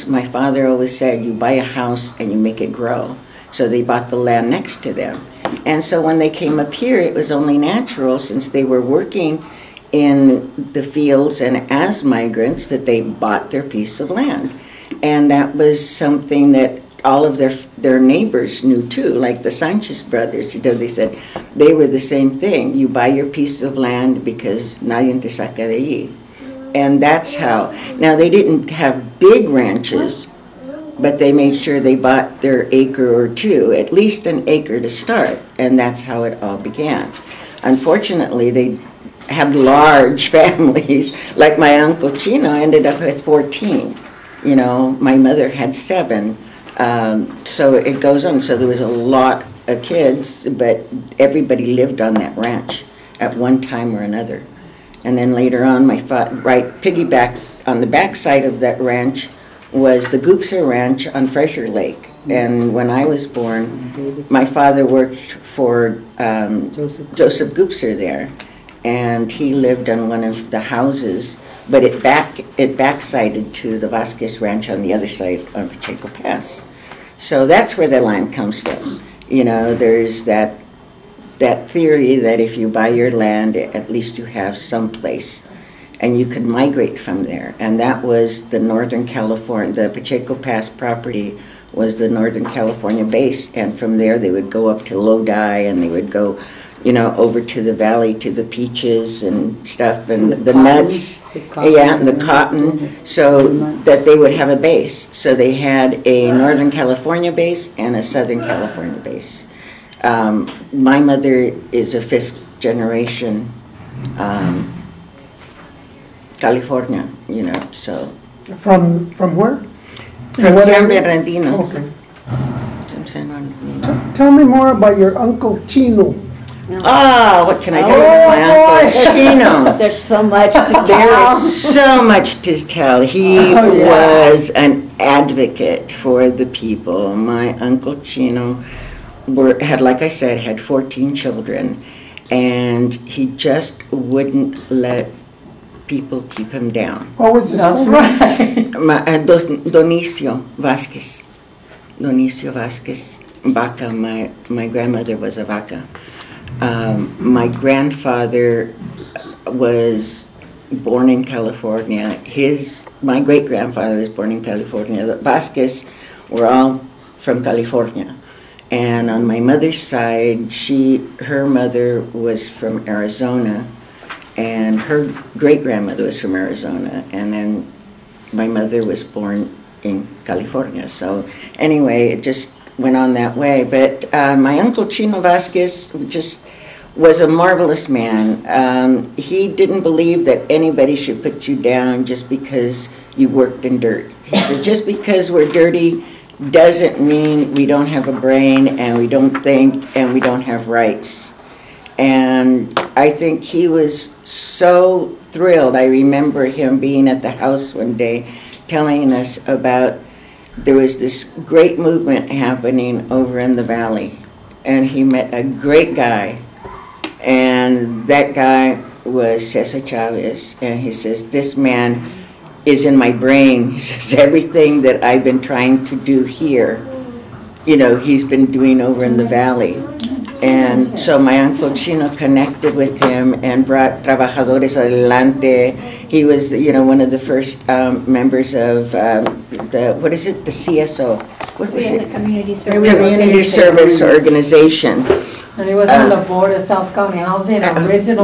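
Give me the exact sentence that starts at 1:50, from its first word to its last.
Um, my mother is a fifth generation um, California, you know, so.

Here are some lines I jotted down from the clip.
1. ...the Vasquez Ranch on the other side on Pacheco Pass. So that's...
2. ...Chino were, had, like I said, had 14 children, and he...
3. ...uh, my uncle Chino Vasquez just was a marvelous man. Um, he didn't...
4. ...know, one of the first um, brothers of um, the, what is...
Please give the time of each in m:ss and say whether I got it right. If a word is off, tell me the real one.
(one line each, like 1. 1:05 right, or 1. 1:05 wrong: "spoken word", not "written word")
1. 1:13 right
2. 2:18 right
3. 3:04 right
4. 3:56 wrong: "members", not "brothers".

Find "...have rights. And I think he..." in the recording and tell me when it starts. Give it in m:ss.
3:20.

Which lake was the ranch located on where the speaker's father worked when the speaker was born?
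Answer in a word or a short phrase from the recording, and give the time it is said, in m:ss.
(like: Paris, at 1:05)
Frazier Lake, at 1:01.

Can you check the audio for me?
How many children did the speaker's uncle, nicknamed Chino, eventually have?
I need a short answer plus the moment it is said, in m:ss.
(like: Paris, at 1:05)
14, at 0:43.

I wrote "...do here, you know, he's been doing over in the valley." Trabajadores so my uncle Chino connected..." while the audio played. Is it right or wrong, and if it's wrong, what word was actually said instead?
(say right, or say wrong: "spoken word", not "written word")
wrong: "And", not "Trabajadores".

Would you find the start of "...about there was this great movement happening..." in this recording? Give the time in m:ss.
3:29.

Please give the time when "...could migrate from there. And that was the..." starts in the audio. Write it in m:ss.
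1:26.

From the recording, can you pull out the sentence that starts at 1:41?
The yeah, and the, oh cotton, so that they would have a base.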